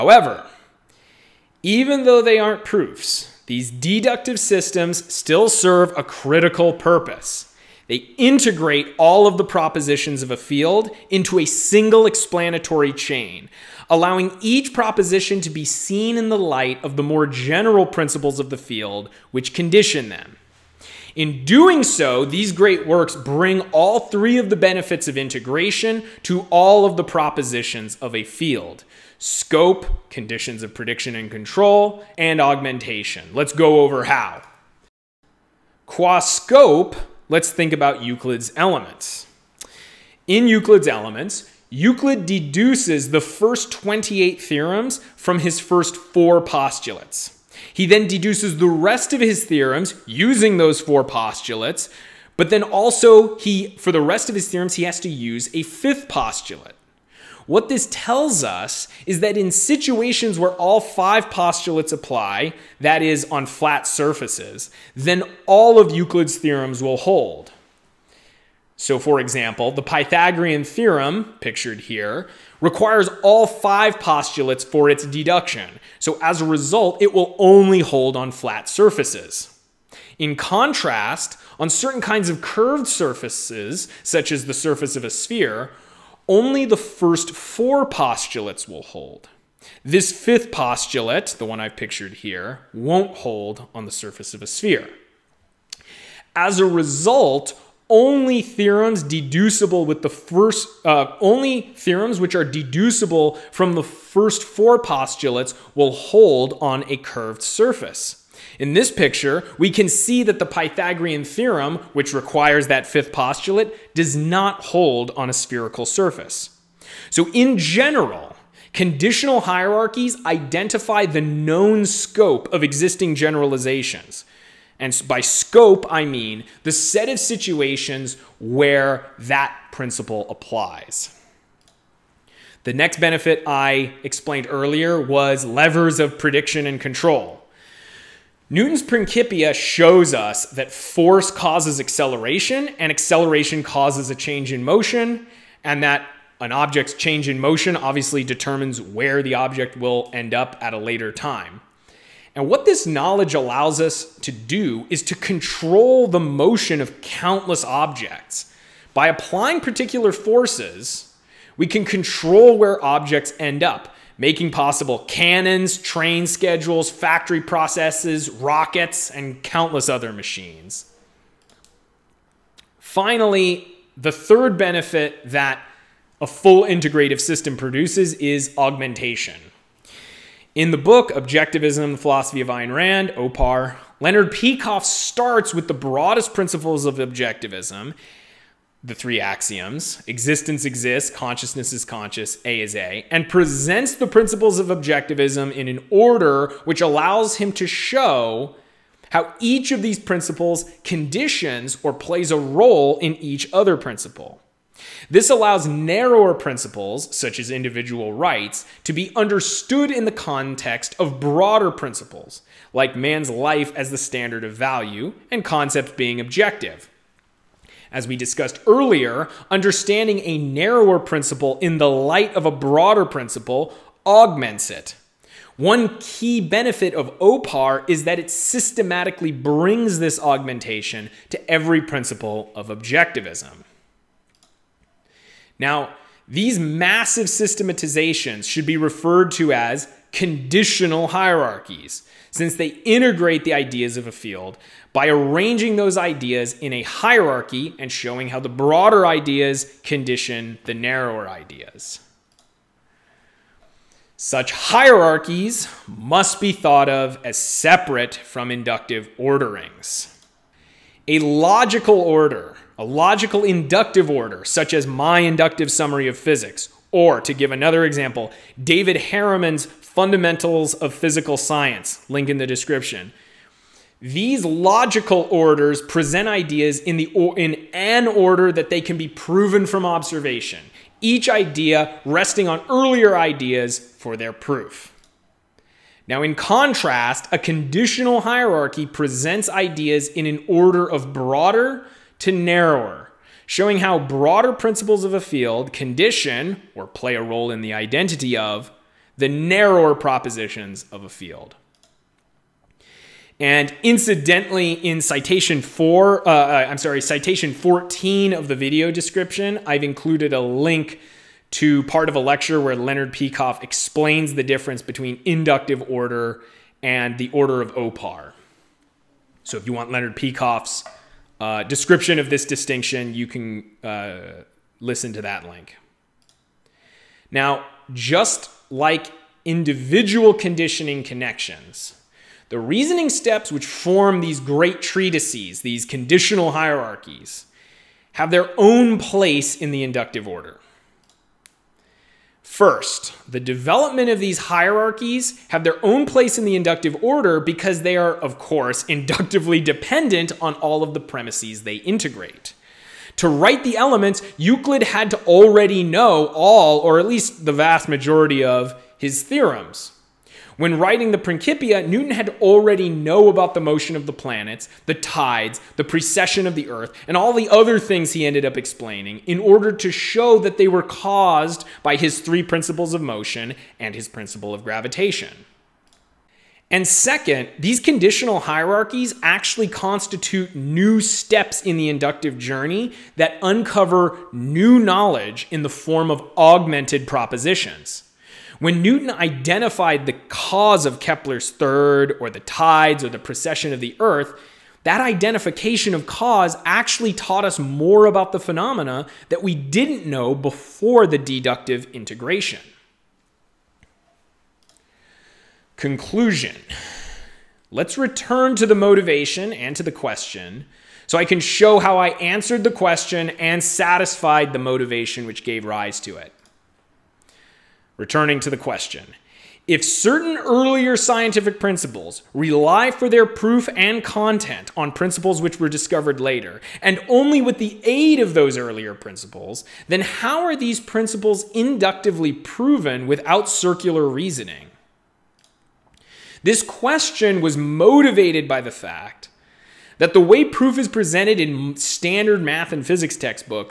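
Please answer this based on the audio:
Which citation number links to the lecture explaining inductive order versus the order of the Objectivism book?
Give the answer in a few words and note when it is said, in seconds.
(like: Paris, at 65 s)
14, at 307 s.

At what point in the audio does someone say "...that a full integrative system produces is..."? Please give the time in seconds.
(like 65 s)
175 s.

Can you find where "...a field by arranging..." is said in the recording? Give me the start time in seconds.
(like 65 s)
244 s.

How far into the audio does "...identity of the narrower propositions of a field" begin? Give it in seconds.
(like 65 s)
297 s.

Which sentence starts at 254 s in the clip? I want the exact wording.
Such hierarchies must be thought of as separate from inductive orderings.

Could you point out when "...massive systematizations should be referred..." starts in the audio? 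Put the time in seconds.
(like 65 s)
236 s.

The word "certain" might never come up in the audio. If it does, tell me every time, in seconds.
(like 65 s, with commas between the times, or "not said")
81 s, 419 s.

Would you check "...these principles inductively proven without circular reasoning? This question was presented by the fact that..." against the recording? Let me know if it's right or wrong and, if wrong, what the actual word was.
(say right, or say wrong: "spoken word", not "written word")
wrong: "motivated", not "presented".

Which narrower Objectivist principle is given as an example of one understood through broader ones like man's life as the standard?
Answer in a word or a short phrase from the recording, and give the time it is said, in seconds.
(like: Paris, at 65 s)
individual rights, at 207 s.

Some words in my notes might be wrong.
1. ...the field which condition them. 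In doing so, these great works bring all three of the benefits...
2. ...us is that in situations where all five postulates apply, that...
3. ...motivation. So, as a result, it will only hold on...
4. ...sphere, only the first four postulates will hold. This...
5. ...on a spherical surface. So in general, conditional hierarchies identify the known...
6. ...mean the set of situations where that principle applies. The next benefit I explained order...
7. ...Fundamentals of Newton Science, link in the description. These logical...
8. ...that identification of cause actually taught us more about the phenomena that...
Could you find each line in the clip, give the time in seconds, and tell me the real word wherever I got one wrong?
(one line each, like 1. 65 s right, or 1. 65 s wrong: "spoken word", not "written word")
1. 18 s right
2. 58 s right
3. 75 s wrong: "deduction", not "motivation"
4. 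85 s right
5. 115 s right
6. 126 s wrong: "earlier", not "order"
7. 269 s wrong: "Physical", not "Newton"
8. 394 s right.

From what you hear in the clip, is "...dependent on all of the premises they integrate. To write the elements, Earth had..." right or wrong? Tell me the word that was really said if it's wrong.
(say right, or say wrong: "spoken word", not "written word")
wrong: "Euclid", not "Earth".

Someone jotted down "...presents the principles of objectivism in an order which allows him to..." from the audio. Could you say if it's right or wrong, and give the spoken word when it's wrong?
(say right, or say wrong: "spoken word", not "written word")
right.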